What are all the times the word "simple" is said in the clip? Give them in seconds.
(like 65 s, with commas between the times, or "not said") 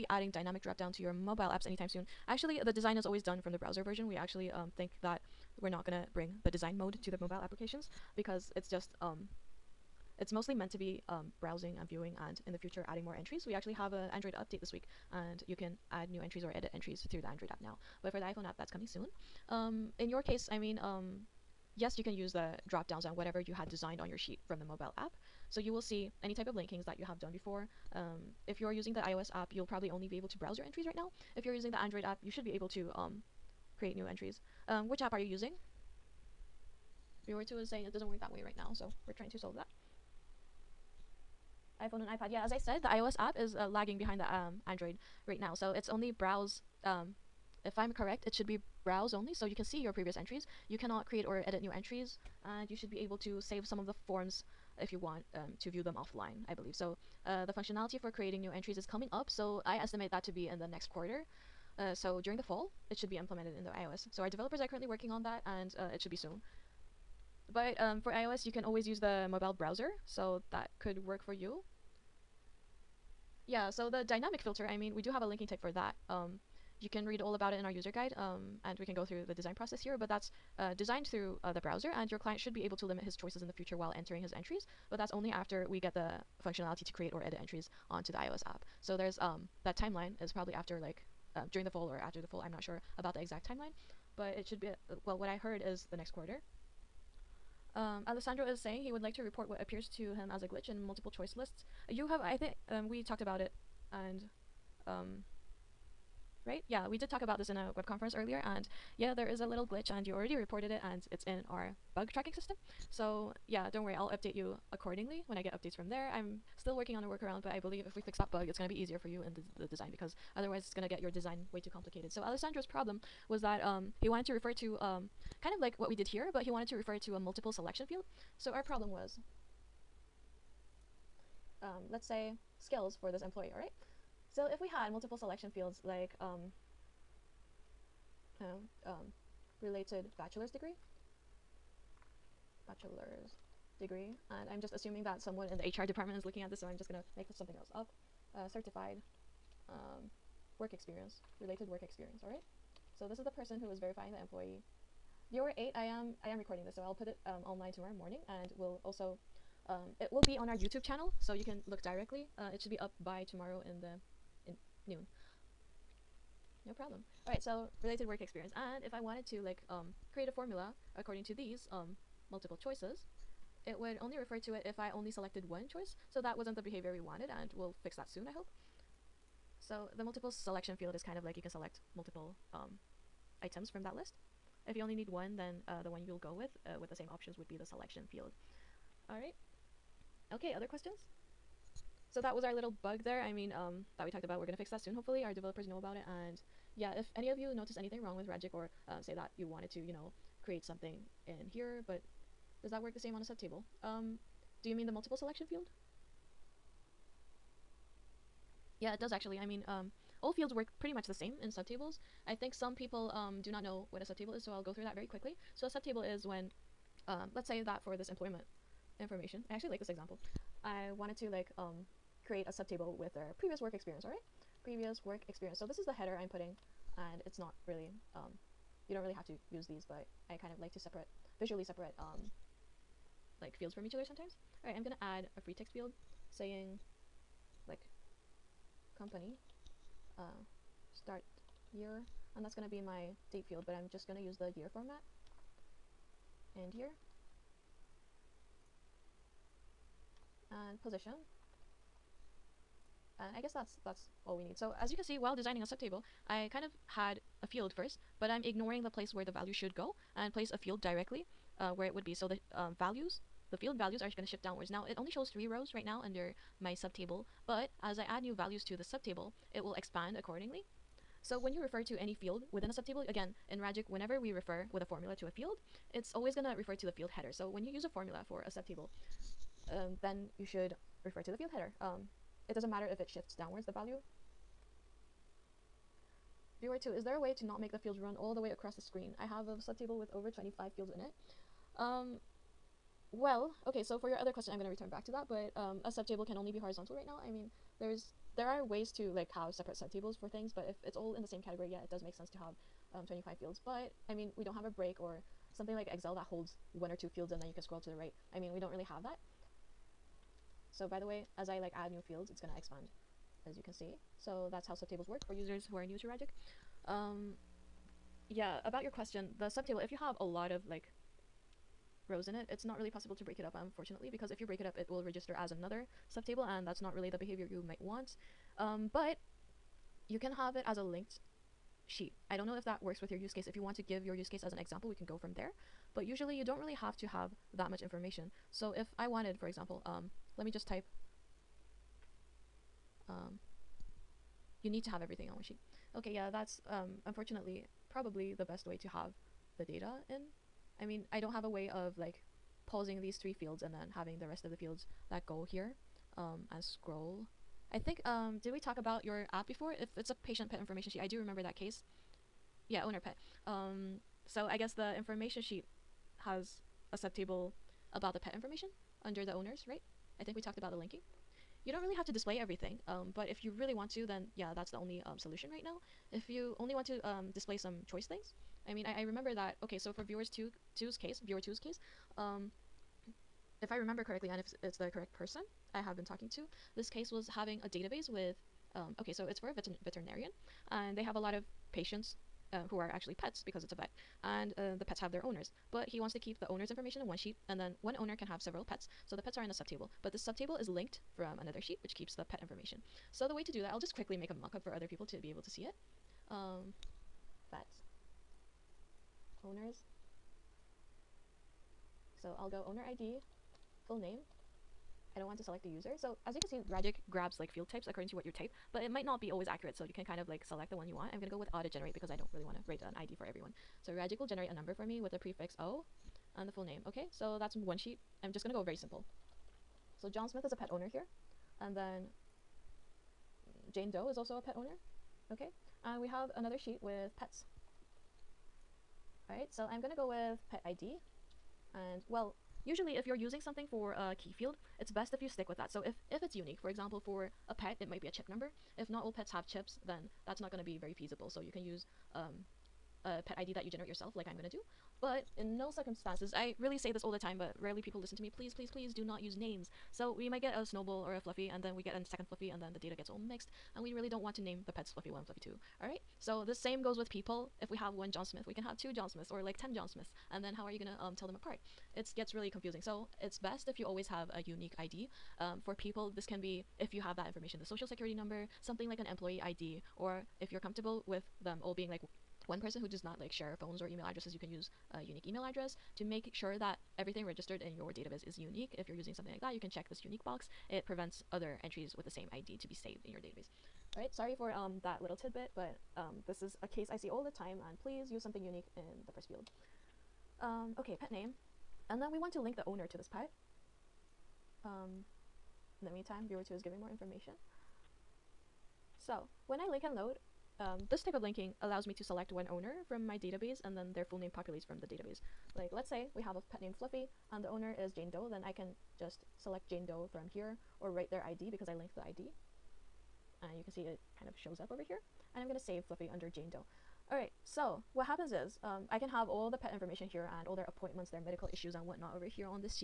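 428 s.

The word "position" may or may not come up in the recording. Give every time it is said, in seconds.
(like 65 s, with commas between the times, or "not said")
250 s.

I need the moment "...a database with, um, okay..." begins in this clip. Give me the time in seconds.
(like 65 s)
387 s.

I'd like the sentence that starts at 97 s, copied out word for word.
Um, Alessandro is saying he would like to report what appears to him as a glitch in multiple choice lists.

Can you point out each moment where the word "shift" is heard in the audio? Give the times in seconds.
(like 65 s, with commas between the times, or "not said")
264 s, 283 s.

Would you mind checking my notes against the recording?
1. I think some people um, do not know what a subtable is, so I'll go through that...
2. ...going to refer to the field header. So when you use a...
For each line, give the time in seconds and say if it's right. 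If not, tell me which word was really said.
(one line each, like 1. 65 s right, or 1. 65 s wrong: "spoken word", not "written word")
1. 212 s right
2. 276 s right.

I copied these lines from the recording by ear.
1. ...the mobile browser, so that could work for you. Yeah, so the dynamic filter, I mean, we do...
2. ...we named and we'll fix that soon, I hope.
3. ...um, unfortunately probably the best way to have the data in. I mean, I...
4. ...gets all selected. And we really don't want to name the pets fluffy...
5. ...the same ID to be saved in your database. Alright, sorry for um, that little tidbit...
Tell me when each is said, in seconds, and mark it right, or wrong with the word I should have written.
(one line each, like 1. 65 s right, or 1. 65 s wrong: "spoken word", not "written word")
1. 68 s right
2. 176 s wrong: "wanted", not "named"
3. 346 s right
4. 462 s wrong: "mixed", not "selected"
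5. 492 s right.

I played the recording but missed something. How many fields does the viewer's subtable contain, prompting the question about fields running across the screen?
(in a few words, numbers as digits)
Over 25.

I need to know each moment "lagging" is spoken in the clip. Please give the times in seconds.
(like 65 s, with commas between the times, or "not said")
43 s.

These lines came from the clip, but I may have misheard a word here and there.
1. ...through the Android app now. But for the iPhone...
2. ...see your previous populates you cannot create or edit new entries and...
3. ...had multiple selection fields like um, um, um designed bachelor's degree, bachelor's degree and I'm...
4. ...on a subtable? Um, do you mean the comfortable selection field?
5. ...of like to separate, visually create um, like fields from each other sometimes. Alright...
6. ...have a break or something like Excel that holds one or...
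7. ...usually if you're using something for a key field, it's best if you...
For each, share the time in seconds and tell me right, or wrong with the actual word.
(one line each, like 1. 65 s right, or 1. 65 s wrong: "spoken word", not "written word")
1. 17 s right
2. 49 s wrong: "entries", not "populates"
3. 134 s wrong: "related", not "designed"
4. 203 s wrong: "multiple", not "comfortable"
5. 230 s wrong: "separate", not "create"
6. 304 s right
7. 442 s right.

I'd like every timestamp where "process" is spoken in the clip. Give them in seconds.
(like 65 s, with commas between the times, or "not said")
79 s.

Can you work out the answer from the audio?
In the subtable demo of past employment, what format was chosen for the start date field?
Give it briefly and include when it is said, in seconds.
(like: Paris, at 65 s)
Year format, at 244 s.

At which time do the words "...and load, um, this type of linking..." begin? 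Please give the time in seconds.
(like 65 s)
509 s.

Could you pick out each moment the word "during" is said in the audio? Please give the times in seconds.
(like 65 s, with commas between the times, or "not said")
62 s, 91 s.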